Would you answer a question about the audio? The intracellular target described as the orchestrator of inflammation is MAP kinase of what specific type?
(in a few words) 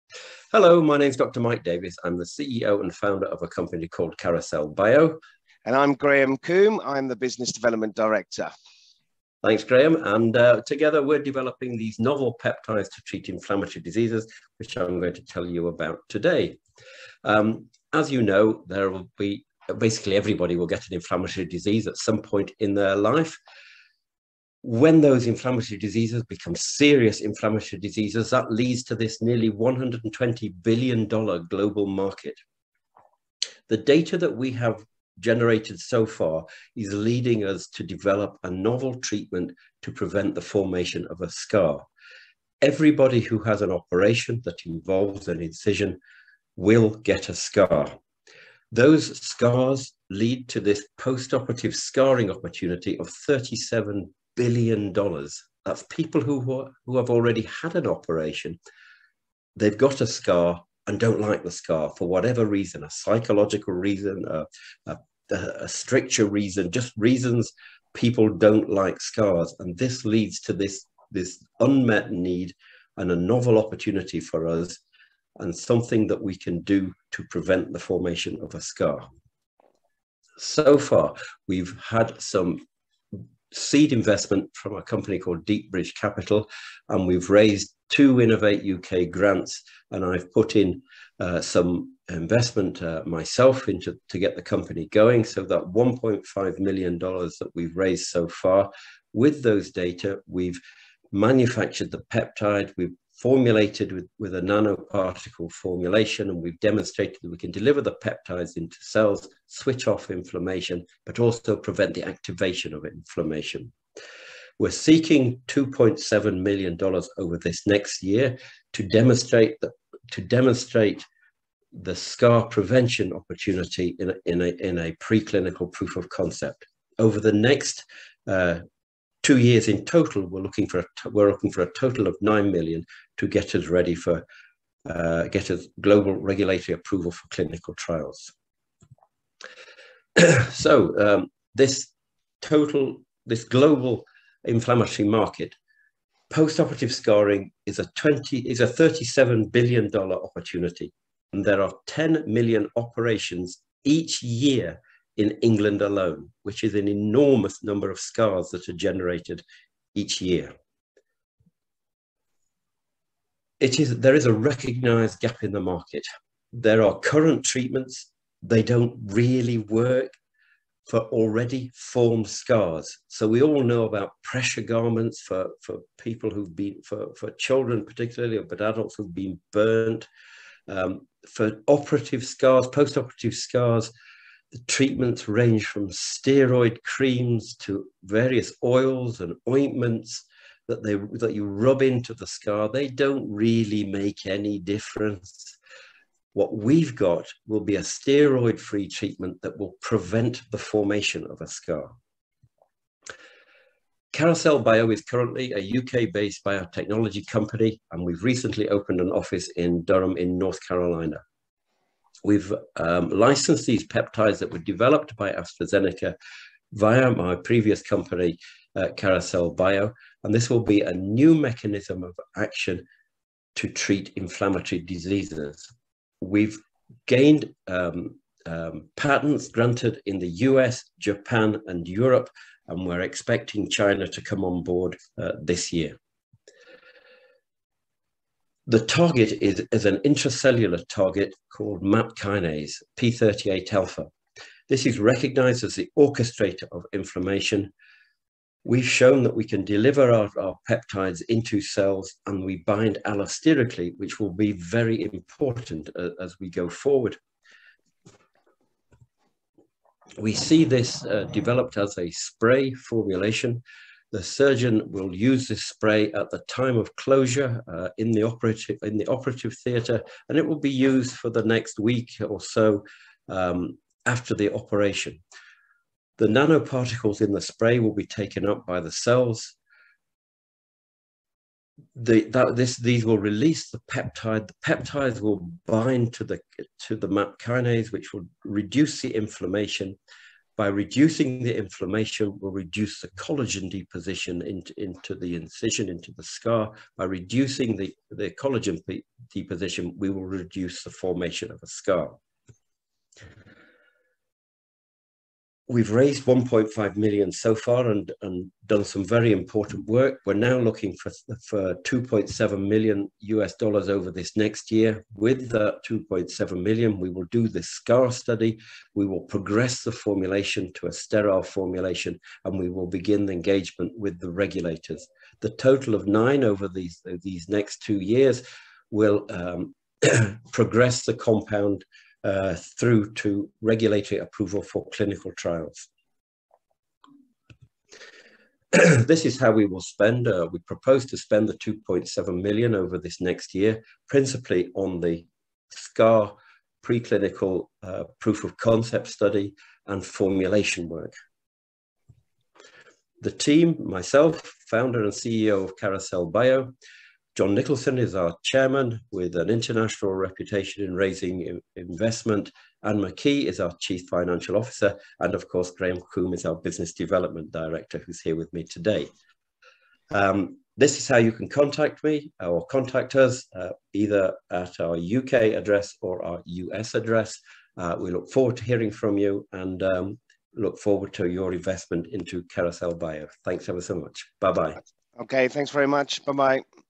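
P38 alpha.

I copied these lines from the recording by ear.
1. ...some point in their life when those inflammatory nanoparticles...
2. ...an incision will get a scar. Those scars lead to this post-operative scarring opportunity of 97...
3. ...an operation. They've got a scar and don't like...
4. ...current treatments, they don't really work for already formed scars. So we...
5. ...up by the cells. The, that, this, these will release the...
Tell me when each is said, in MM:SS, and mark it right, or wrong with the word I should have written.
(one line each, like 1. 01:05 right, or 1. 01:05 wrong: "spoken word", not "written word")
1. 00:21 wrong: "diseases", not "nanoparticles"
2. 00:45 wrong: "37", not "97"
3. 00:57 right
4. 02:46 right
5. 04:38 right.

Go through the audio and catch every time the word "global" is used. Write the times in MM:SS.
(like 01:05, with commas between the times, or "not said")
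00:31, 02:15, 02:23.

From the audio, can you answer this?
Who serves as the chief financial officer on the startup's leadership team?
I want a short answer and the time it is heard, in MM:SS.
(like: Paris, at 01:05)
Anne McKee, at 06:02.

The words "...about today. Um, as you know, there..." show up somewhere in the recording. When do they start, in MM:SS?
00:15.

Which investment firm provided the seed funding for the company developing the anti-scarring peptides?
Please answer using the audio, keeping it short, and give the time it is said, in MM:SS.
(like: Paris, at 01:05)
Deepbridge Capital, at 01:25.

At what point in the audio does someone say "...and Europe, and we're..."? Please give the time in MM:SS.
03:51.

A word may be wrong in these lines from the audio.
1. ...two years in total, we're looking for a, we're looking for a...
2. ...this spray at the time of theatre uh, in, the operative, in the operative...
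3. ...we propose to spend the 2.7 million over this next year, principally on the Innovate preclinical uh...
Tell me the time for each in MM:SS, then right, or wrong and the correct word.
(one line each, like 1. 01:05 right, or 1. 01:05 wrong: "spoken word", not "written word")
1. 02:09 right
2. 04:25 wrong: "closure", not "theatre"
3. 05:40 wrong: "SCAR", not "Innovate".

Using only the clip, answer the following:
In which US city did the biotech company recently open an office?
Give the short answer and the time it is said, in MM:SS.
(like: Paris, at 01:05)
Durham, at 03:29.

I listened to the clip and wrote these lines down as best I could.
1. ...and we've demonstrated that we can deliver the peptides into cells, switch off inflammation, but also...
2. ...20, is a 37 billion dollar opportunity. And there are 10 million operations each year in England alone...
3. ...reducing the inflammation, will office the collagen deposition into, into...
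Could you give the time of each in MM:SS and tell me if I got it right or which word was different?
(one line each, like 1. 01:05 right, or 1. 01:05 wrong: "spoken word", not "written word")
1. 01:46 right
2. 02:27 right
3. 04:50 wrong: "reduce", not "office".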